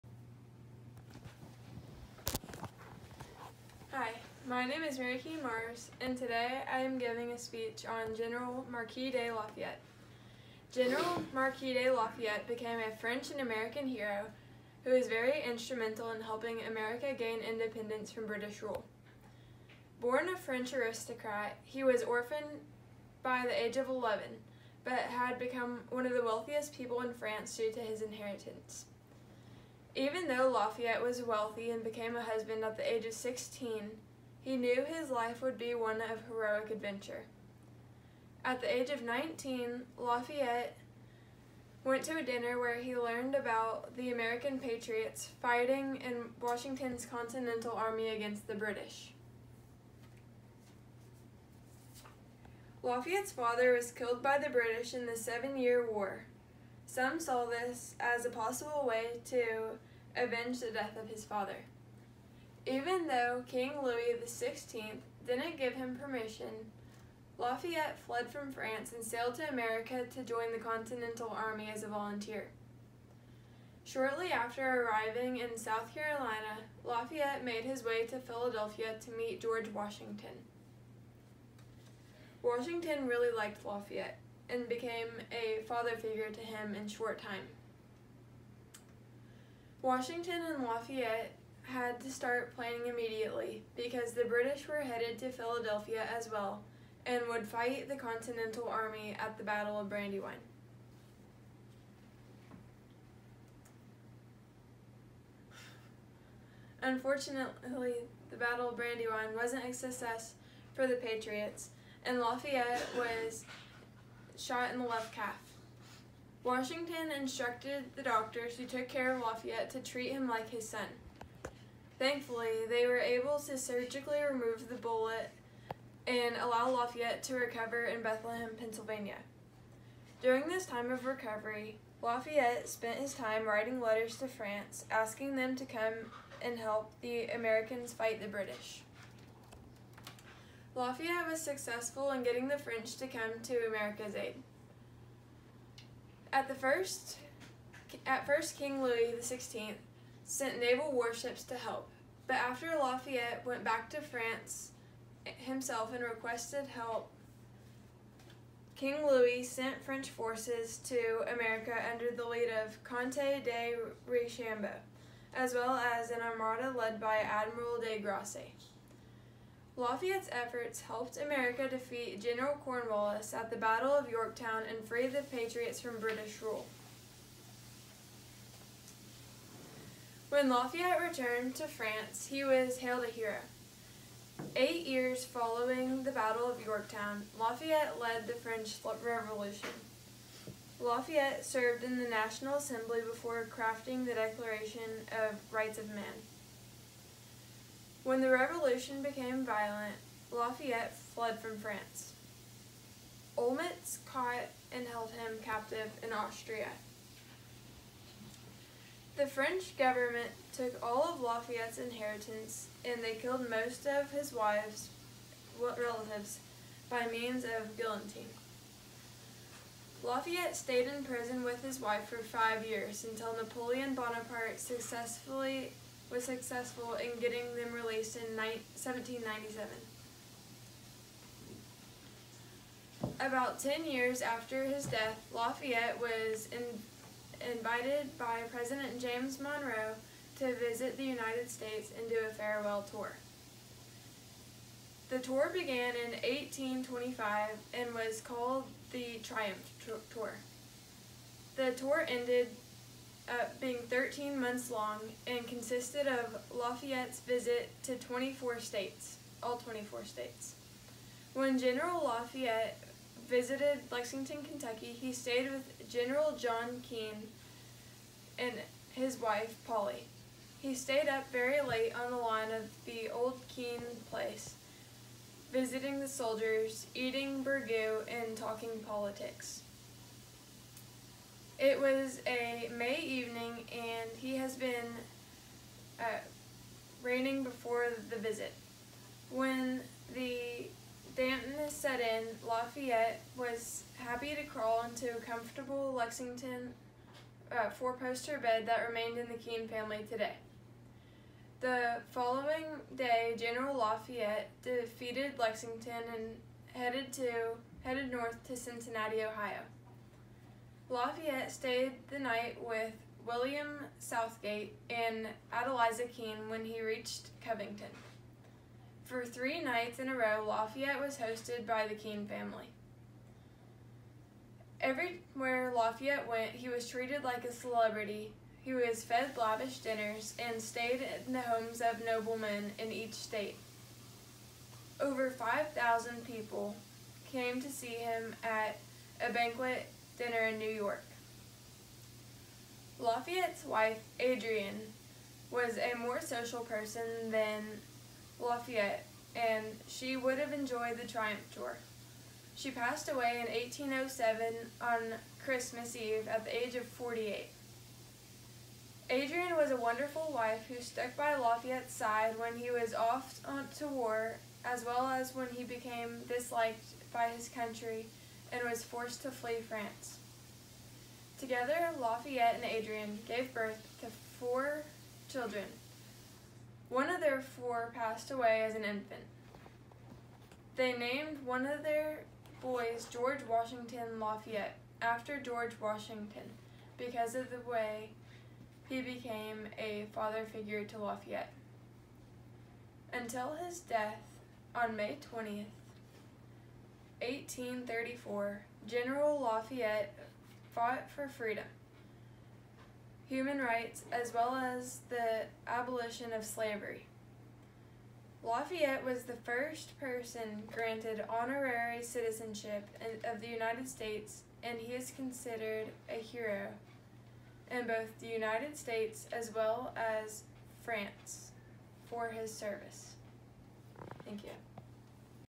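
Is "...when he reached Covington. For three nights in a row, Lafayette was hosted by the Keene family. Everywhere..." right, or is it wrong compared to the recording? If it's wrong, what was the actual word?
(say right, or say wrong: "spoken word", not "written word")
right.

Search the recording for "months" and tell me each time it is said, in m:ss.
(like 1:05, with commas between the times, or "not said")
4:14.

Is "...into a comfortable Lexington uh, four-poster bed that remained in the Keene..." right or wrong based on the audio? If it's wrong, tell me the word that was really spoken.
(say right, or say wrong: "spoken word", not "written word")
right.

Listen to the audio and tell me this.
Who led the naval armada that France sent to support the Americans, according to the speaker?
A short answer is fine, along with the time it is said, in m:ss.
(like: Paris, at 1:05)
Admiral de Grasse, at 2:47.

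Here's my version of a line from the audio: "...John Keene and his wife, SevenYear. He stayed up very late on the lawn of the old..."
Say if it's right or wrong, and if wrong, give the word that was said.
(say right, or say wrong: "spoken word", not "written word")
wrong: "Polly", not "SevenYear".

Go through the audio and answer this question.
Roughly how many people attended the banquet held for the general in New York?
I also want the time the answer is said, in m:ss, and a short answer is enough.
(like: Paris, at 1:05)
Over 5,000, at 5:35.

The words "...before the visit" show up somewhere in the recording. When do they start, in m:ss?
4:47.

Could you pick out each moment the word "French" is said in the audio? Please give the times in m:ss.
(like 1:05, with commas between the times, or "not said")
0:12, 0:20, 2:22, 2:39, 3:08, 3:29.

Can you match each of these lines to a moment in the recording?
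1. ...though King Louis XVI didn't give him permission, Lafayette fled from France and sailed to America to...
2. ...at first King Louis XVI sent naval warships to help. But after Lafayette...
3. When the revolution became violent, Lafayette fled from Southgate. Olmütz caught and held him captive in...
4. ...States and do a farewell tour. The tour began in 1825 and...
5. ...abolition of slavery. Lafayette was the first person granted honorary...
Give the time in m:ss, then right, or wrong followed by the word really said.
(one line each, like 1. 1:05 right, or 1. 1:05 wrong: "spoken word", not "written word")
1. 1:03 right
2. 2:28 right
3. 3:18 wrong: "France", not "Southgate"
4. 4:01 right
5. 6:45 right.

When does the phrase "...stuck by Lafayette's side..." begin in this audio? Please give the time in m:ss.
6:00.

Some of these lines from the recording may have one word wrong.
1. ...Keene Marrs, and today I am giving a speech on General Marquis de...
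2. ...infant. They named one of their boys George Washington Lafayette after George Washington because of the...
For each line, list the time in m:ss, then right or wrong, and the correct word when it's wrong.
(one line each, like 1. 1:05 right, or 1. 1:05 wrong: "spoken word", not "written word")
1. 0:05 right
2. 6:18 right.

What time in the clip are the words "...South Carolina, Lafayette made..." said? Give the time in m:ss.
1:15.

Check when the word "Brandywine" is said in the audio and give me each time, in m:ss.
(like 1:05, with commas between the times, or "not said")
1:39, 1:48.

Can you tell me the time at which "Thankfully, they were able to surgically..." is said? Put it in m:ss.
2:02.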